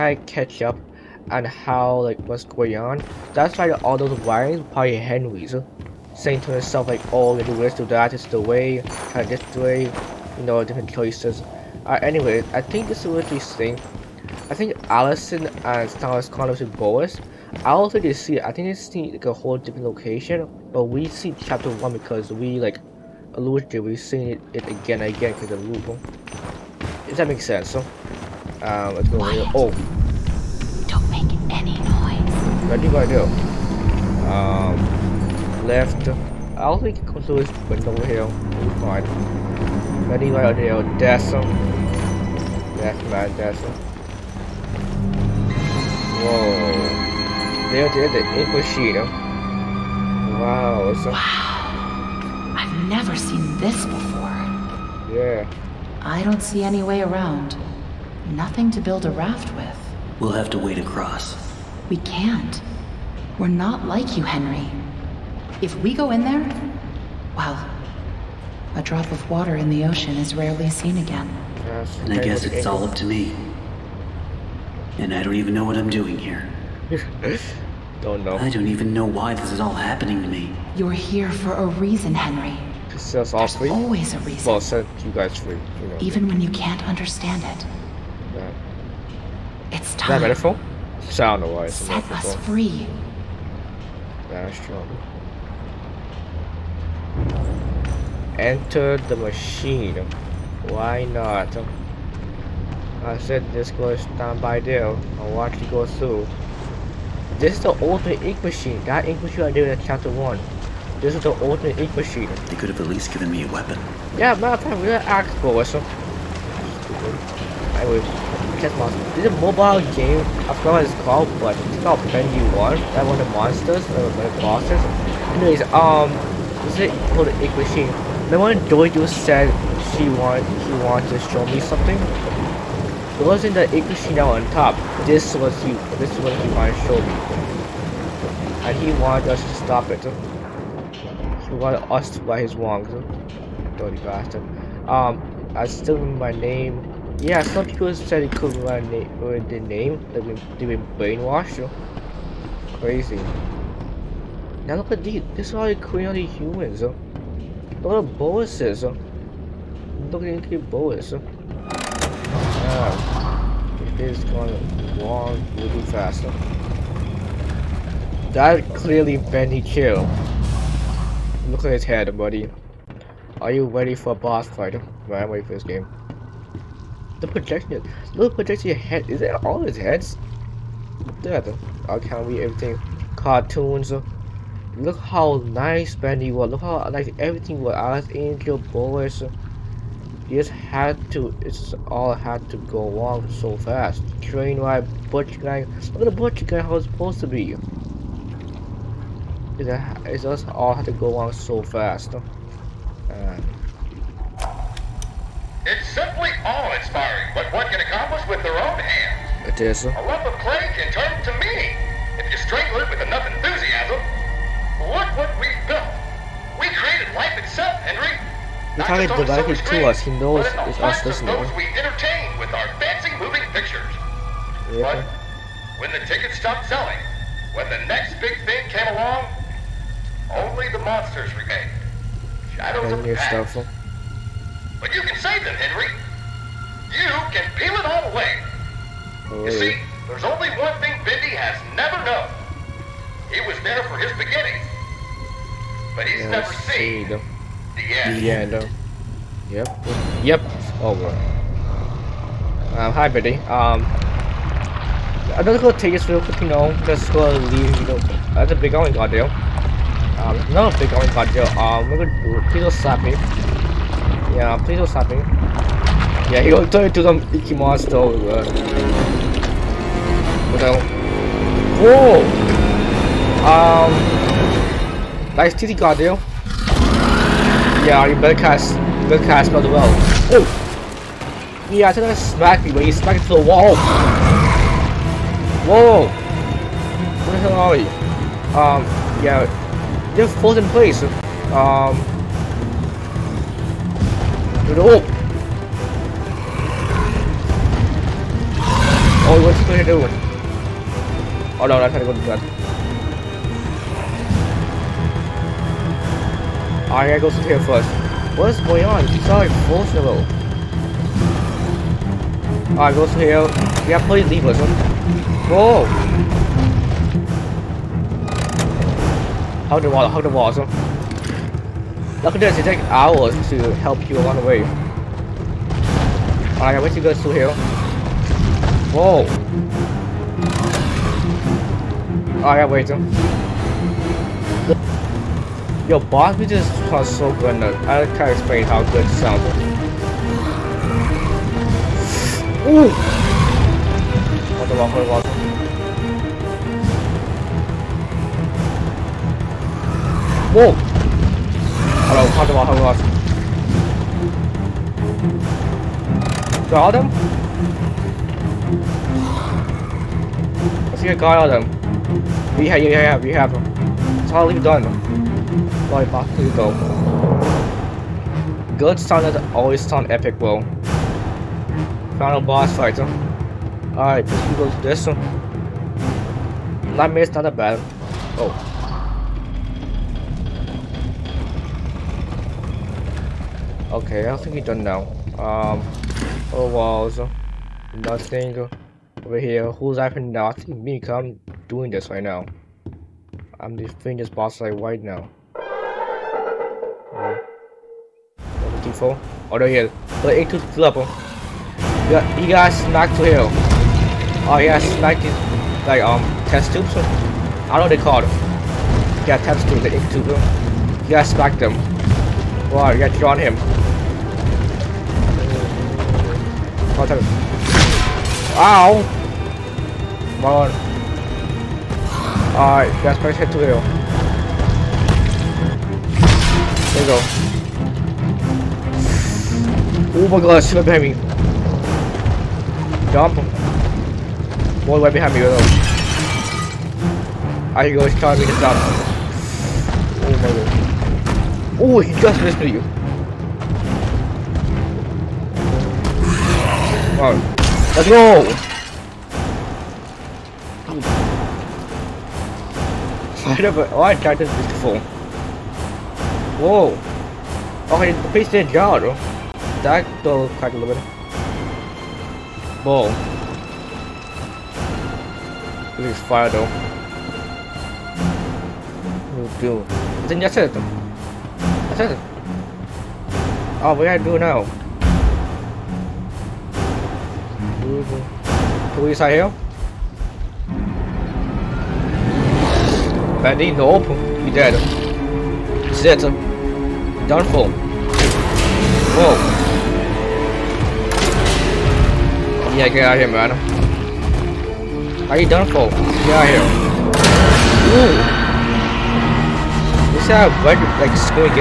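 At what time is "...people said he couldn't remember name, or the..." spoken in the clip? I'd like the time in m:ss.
2:27.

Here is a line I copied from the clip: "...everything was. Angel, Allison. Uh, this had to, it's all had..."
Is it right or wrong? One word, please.
wrong.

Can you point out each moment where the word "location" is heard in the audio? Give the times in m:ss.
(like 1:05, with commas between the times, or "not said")
0:19.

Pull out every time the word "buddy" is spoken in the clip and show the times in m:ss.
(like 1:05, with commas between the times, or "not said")
2:52, 4:13.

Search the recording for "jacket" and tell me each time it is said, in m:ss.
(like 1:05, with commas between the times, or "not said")
not said.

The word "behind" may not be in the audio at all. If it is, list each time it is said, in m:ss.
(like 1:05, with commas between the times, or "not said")
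7:10, 7:15.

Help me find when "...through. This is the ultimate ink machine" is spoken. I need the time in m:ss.
1:45.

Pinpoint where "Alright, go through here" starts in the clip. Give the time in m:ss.
5:12.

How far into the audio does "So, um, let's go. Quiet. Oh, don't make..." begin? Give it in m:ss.
0:27.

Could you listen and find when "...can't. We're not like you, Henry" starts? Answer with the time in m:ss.
1:01.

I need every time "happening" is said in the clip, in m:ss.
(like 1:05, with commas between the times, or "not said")
1:19, 6:29.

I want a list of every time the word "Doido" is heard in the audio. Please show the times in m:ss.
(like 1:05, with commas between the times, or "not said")
2:08.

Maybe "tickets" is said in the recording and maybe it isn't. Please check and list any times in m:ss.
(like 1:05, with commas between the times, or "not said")
3:46.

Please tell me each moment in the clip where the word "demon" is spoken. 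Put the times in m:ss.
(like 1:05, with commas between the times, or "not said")
not said.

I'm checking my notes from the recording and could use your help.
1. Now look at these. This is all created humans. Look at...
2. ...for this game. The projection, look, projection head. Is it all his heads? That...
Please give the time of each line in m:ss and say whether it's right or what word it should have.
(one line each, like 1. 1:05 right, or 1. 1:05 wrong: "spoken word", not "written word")
1. 2:34 right
2. 2:55 right.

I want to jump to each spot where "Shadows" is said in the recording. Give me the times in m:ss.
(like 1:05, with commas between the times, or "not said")
3:52.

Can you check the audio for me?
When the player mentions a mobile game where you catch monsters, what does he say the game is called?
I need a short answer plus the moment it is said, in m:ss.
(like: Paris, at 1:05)
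Pendy 1, at 2:02.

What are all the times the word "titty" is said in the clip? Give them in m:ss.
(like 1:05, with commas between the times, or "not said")
4:35.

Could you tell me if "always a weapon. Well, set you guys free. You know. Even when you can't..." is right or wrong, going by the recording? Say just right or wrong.
wrong.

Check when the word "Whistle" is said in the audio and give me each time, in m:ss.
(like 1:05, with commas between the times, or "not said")
1:55.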